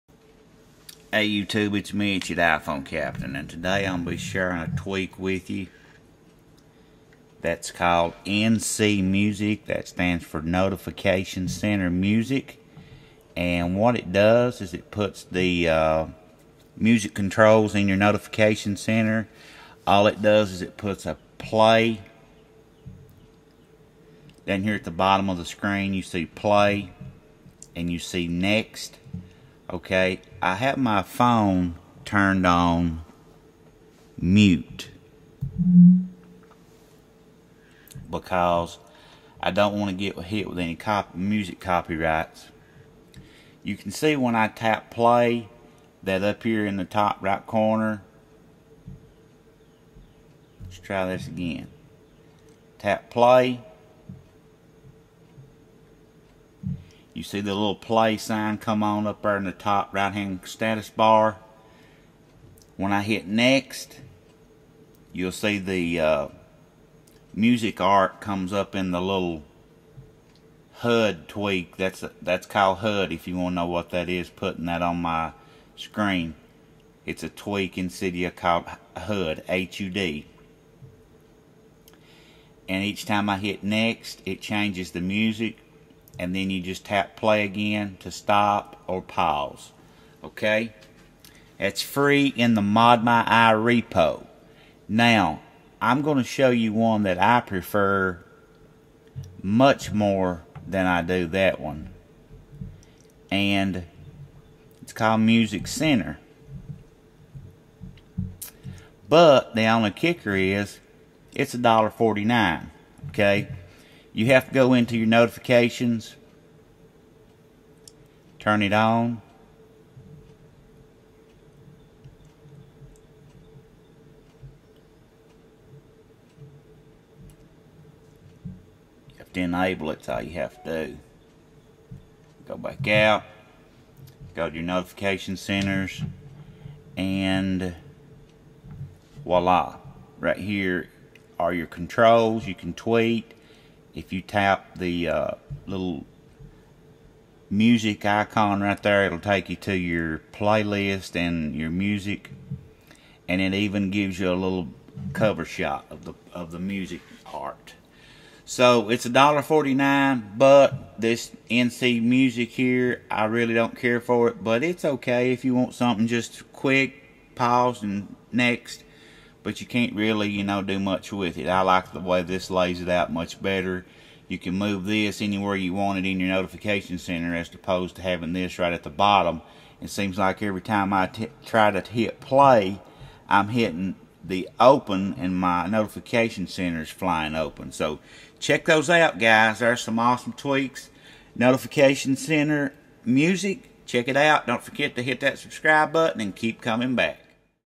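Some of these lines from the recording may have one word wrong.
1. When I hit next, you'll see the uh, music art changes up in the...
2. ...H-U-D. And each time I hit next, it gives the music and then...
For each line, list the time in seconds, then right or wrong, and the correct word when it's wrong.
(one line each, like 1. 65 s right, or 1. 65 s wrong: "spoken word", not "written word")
1. 62 s wrong: "comes", not "changes"
2. 79 s wrong: "changes", not "gives".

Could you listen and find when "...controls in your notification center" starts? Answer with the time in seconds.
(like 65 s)
17 s.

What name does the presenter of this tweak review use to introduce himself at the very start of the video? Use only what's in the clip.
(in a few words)
iPhone Captain.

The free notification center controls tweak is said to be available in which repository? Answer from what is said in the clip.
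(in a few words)
ModMyi.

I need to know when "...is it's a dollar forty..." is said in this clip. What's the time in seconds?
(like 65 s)
110 s.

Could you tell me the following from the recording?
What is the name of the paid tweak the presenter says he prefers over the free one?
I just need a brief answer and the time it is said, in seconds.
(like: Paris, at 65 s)
Music Center, at 105 s.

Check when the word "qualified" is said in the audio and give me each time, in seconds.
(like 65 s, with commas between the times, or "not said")
not said.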